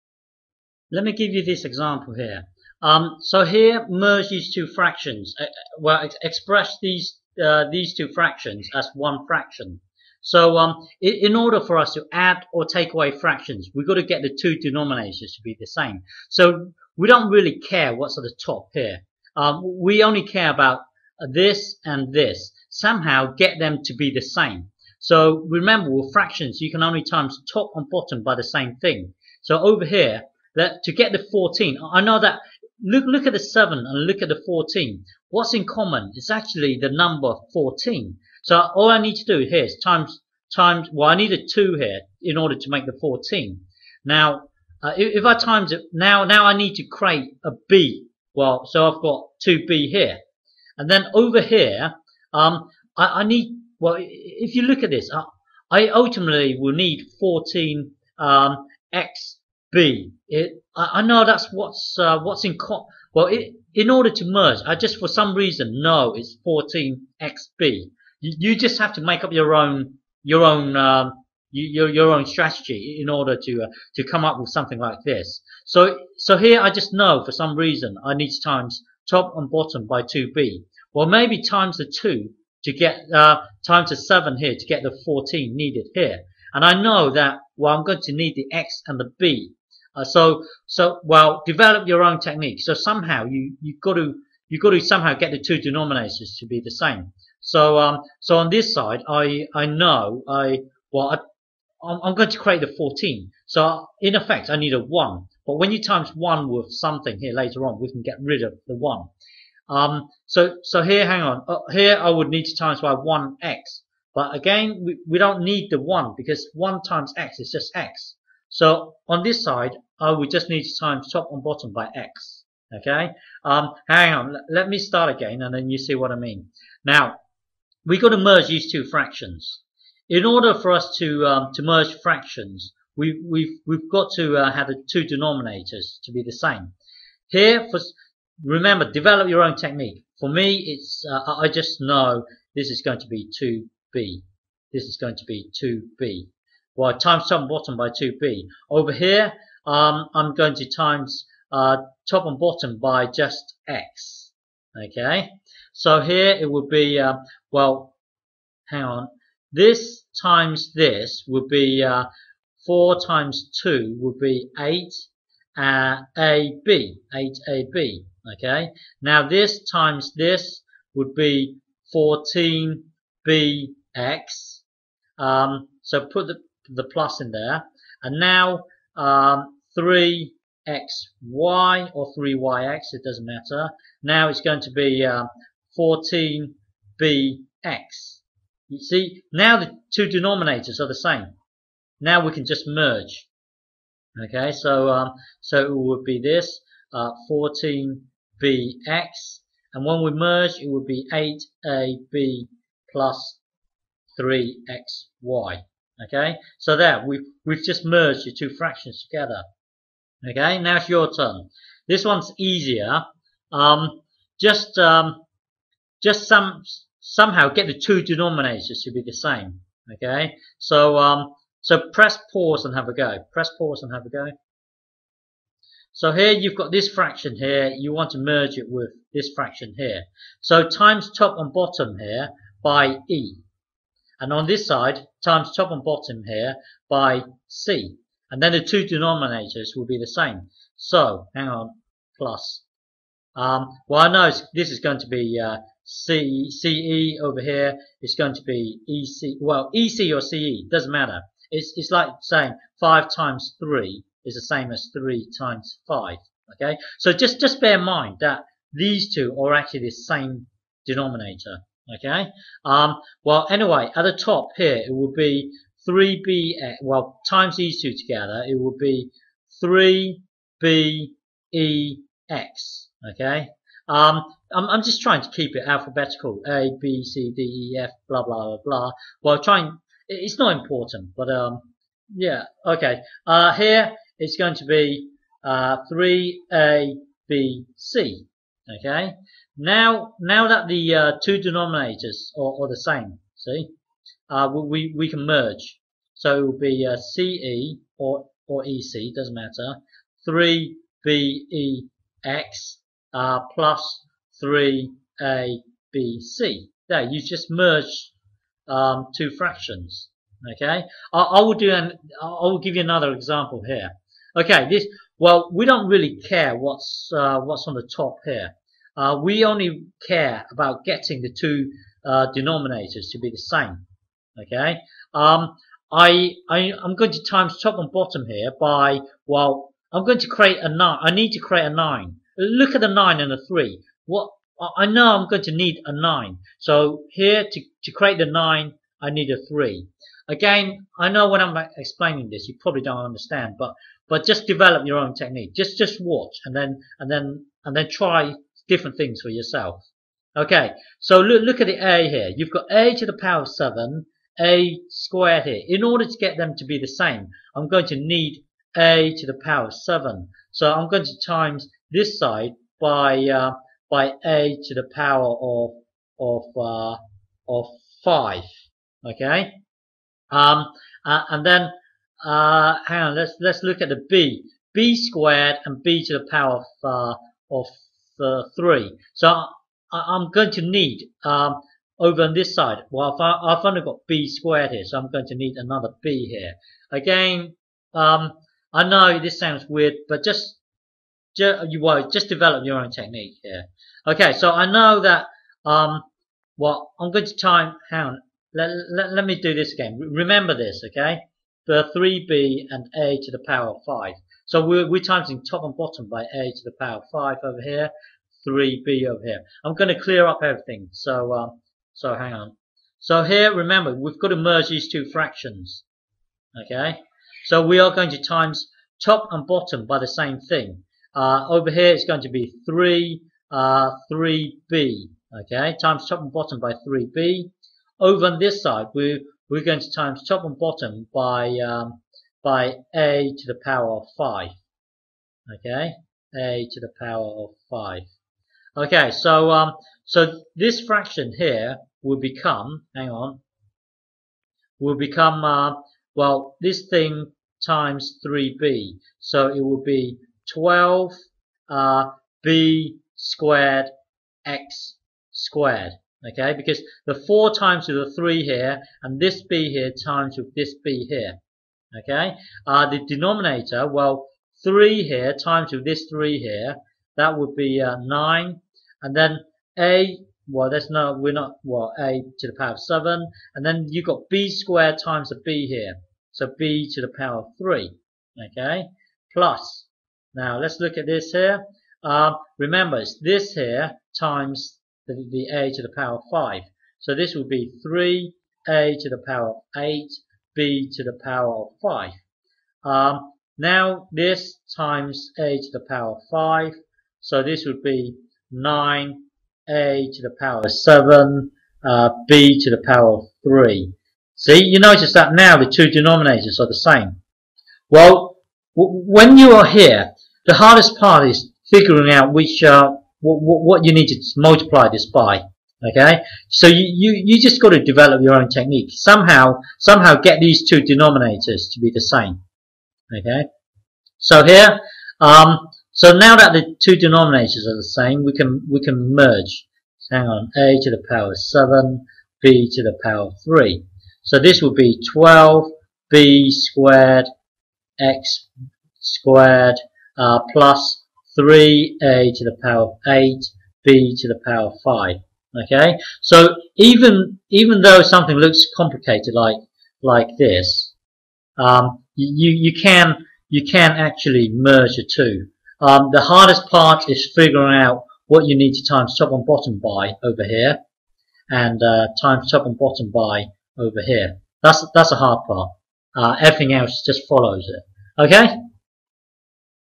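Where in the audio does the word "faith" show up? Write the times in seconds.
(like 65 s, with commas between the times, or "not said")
not said.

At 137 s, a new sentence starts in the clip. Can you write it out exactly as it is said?
Here, for remember, develop your own technique.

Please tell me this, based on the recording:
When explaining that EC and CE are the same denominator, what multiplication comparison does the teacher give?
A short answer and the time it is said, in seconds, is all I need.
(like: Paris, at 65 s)
5 times 3, at 252 s.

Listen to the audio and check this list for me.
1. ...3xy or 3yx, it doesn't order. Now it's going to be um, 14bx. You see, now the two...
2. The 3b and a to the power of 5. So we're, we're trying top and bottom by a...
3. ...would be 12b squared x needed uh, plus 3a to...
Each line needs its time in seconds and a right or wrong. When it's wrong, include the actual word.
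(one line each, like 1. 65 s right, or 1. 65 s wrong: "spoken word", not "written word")
1. 179 s wrong: "matter", not "order"
2. 401 s wrong: "timesing", not "trying"
3. 534 s wrong: "squared", not "needed".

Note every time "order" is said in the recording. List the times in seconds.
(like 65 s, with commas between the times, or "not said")
11 s, 42 s, 63 s, 73 s, 130 s, 355 s.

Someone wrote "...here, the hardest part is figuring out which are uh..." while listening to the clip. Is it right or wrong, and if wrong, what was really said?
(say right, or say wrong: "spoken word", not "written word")
right.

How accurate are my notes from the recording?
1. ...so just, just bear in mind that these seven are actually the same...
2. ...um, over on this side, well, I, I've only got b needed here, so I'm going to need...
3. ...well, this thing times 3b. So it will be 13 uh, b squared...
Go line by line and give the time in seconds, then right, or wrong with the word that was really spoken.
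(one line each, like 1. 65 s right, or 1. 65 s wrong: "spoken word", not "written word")
1. 256 s wrong: "two", not "seven"
2. 381 s wrong: "squared", not "needed"
3. 446 s wrong: "12", not "13".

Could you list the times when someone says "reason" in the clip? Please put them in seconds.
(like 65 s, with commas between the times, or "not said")
65 s, 77 s.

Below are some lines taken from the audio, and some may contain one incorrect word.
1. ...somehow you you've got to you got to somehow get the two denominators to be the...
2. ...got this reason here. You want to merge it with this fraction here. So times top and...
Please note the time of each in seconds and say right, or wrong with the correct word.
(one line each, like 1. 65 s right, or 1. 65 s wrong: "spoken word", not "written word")
1. 92 s right
2. 226 s wrong: "fraction", not "reason".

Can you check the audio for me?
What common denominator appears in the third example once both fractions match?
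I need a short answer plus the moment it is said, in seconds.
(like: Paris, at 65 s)
9a^7b^3, at 498 s.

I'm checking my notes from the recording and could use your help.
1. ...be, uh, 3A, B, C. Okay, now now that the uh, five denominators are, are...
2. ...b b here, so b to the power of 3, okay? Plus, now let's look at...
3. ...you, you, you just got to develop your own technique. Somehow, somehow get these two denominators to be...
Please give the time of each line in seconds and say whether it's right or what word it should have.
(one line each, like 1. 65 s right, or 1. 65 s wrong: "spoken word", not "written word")
1. 284 s wrong: "two", not "five"
2. 475 s right
3. 516 s right.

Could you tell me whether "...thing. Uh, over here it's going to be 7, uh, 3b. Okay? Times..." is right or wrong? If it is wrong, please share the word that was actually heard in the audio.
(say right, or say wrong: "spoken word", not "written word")
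wrong: "3", not "7".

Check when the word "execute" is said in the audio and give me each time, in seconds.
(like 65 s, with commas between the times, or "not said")
not said.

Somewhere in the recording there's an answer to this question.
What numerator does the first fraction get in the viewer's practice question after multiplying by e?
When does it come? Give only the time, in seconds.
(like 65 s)
269 s.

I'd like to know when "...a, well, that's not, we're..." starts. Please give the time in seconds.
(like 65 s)
469 s.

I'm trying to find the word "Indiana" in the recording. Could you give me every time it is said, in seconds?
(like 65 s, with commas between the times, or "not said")
not said.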